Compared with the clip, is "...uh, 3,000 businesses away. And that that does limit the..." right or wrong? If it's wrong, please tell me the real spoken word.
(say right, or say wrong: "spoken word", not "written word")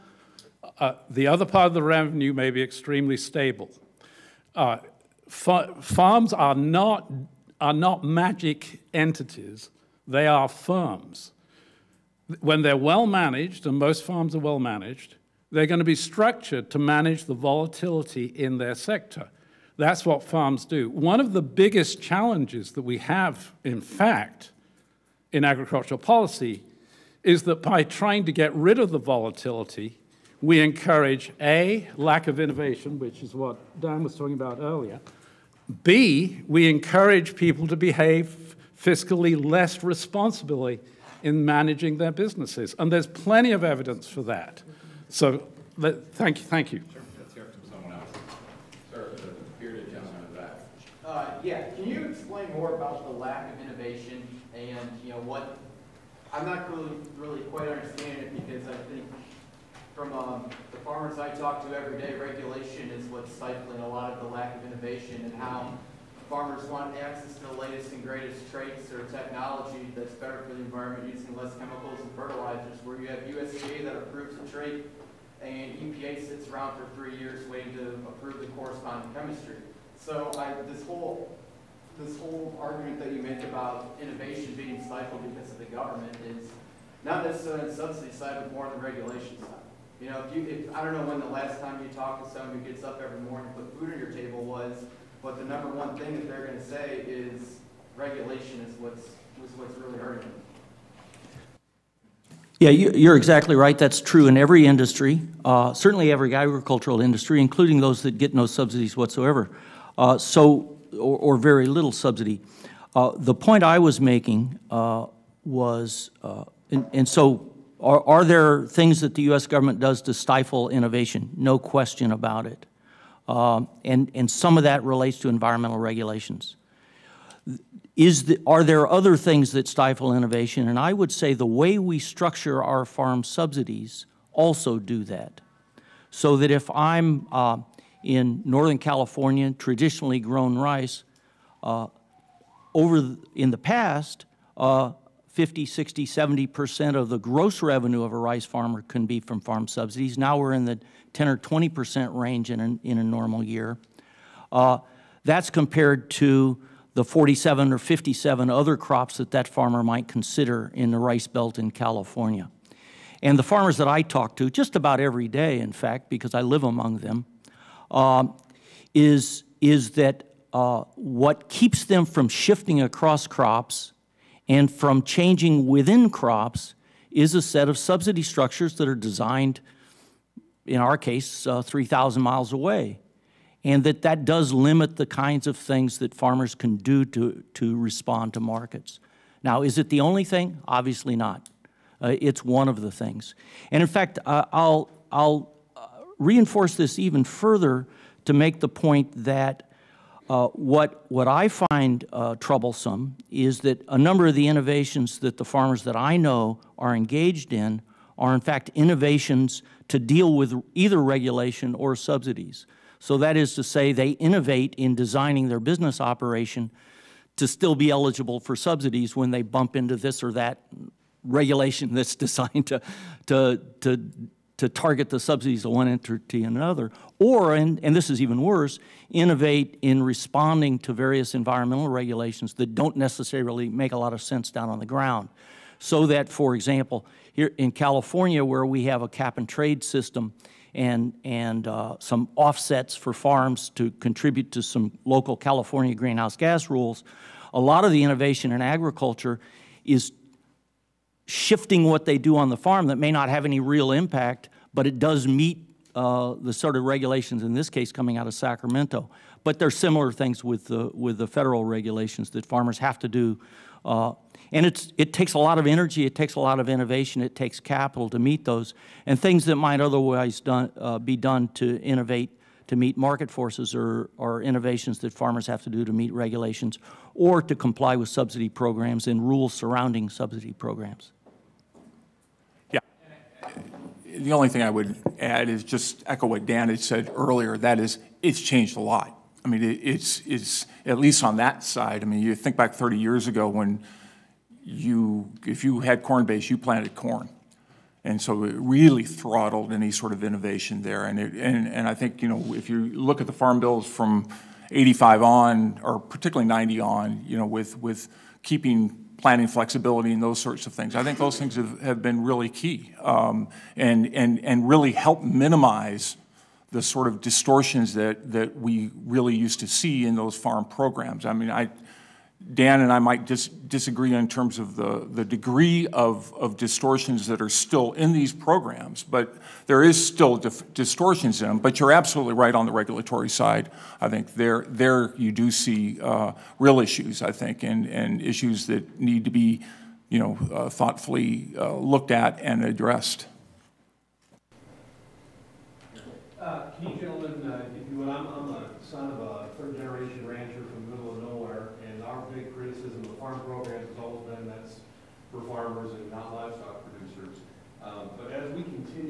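wrong: "miles", not "businesses".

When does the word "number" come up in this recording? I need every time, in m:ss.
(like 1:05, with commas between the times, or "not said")
1:35, 3:23.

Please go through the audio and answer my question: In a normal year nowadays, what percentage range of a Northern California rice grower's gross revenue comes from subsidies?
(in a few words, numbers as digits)
10 or 20 percent.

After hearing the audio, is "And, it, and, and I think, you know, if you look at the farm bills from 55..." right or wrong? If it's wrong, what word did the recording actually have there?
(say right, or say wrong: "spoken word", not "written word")
wrong: "85", not "55".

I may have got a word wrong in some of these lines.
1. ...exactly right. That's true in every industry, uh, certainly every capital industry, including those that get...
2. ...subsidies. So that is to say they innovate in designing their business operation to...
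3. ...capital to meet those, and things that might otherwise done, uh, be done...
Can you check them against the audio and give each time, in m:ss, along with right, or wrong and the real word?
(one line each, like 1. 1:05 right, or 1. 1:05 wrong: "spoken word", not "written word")
1. 1:43 wrong: "agricultural", not "capital"
2. 3:31 right
3. 4:27 right.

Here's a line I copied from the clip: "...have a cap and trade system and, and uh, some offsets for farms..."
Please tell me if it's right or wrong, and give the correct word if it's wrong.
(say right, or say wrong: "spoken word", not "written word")
right.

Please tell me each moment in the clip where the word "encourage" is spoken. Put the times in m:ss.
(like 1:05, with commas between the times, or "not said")
0:30, 0:36.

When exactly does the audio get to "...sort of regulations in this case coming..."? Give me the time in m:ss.
4:16.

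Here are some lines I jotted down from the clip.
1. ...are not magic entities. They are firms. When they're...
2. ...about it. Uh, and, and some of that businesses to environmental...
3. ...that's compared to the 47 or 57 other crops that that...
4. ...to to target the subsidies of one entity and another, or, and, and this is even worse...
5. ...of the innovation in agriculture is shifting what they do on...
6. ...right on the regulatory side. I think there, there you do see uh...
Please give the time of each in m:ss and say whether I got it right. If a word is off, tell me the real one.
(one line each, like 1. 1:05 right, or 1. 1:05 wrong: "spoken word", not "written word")
1. 0:07 right
2. 2:02 wrong: "relates", not "businesses"
3. 2:35 right
4. 3:43 right
5. 4:07 right
6. 5:32 right.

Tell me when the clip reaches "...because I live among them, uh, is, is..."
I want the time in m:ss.
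2:46.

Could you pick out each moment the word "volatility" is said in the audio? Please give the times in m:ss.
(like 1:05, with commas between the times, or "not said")
0:17, 0:28.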